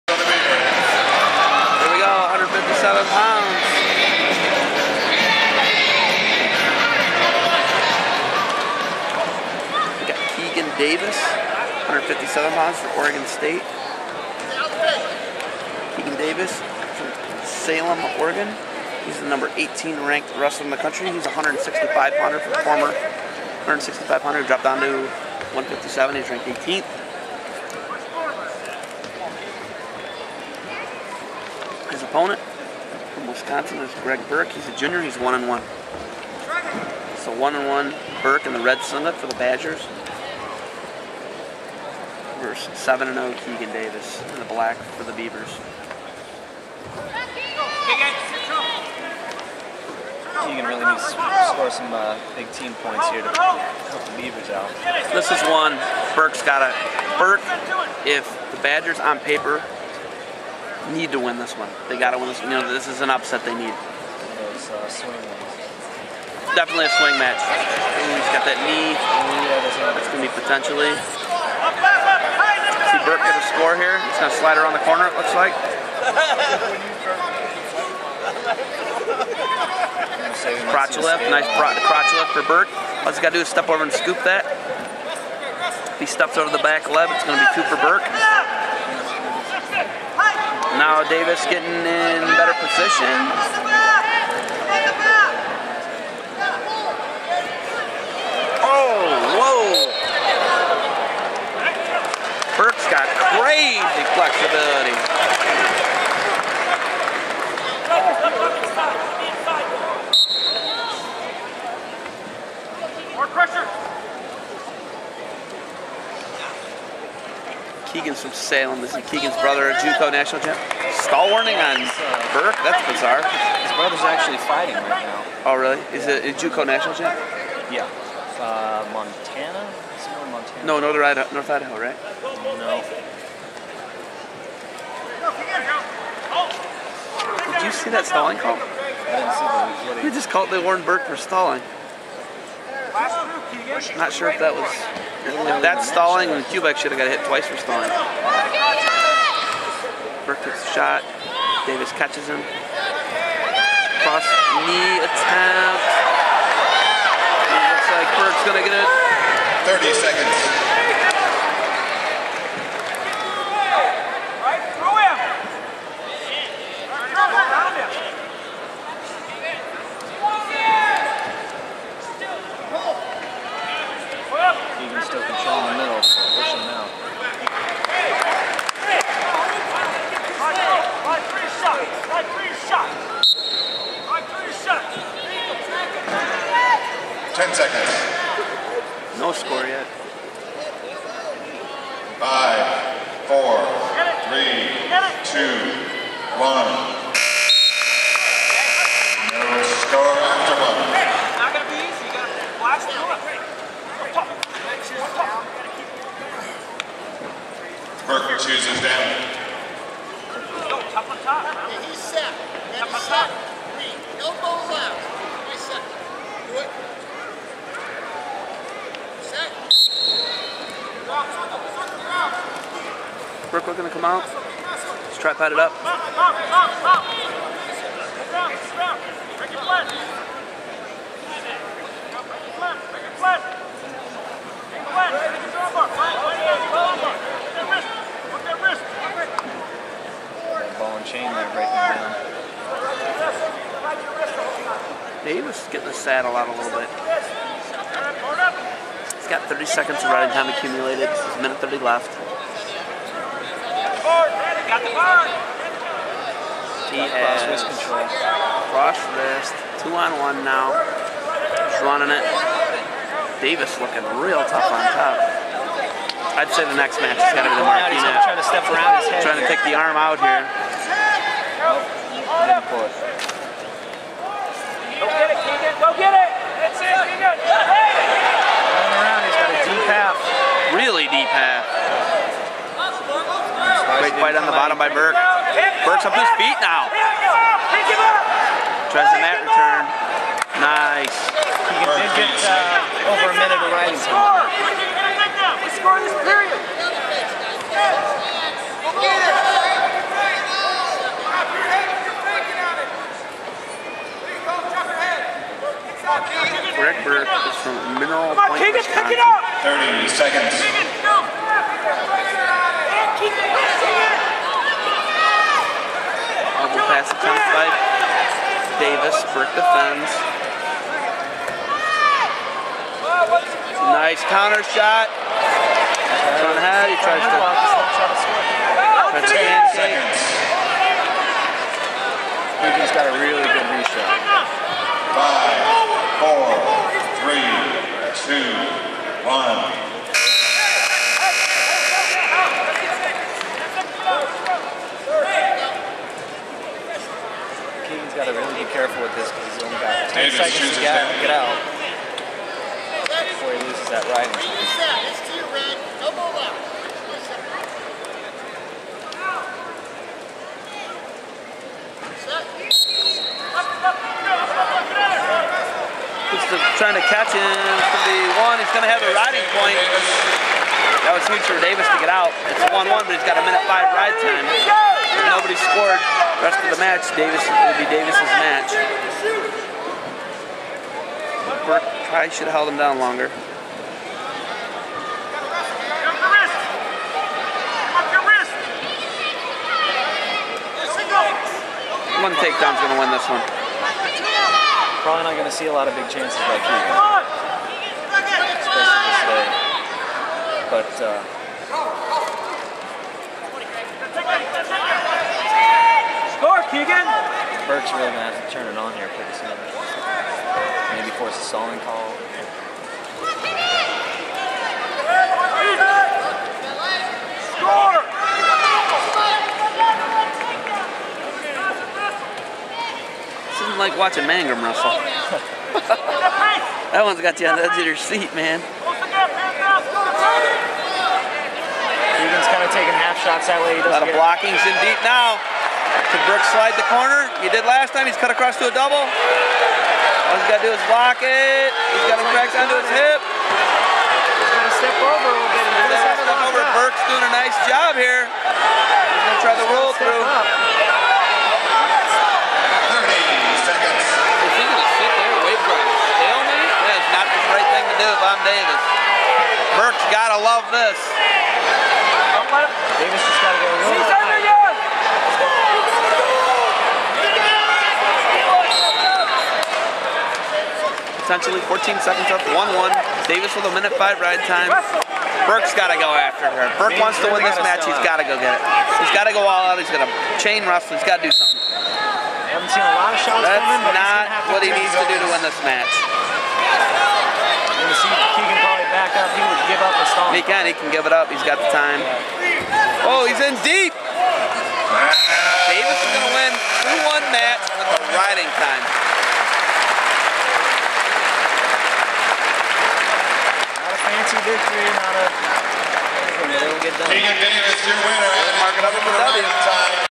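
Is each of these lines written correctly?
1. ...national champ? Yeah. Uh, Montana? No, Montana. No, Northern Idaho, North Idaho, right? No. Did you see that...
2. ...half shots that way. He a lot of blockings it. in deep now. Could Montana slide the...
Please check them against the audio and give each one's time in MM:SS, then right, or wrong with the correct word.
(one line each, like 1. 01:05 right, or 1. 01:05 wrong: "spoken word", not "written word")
1. 02:06 right
2. 07:12 wrong: "Brooks", not "Montana".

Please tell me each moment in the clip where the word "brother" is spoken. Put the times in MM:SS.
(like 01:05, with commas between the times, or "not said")
01:59, 02:03.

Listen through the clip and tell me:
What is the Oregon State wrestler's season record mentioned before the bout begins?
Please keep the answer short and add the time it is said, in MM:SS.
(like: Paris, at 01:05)
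7-0, at 00:42.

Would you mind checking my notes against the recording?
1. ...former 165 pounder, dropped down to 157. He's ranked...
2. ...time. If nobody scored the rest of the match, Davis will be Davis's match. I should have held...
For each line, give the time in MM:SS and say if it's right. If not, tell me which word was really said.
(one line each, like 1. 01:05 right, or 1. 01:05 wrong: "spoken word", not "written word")
1. 00:22 right
2. 06:14 right.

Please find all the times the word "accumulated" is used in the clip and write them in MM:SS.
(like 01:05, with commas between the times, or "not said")
04:10.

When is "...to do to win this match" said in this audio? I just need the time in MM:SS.
08:04.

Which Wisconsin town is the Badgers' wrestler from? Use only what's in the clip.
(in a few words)
Mineral Point, Wisconsin.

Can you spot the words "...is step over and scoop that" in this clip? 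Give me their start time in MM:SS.
01:23.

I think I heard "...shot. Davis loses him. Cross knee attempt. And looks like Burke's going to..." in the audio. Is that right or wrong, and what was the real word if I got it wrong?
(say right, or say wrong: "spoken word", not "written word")
wrong: "catches", not "loses".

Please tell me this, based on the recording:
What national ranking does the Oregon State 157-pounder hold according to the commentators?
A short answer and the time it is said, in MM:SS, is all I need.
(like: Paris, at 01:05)
18, at 00:19.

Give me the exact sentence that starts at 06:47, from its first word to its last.
Burke's really going to have to turn it on here pretty soon force a stalling call.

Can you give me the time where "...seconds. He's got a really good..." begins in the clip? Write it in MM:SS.
05:29.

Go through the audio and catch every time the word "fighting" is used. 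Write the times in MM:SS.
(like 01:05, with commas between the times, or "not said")
02:04.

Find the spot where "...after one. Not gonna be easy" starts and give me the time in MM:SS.
03:20.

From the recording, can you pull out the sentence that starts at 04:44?
right on the bottom by Burke.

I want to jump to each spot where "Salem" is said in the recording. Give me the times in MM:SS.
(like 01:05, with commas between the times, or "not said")
00:17, 01:58.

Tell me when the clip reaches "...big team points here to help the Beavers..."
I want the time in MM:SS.
00:52.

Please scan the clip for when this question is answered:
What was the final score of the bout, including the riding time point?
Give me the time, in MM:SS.
08:17.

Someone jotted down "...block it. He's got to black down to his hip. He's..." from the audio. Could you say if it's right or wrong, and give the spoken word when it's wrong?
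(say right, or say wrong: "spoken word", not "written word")
wrong: "crack", not "black".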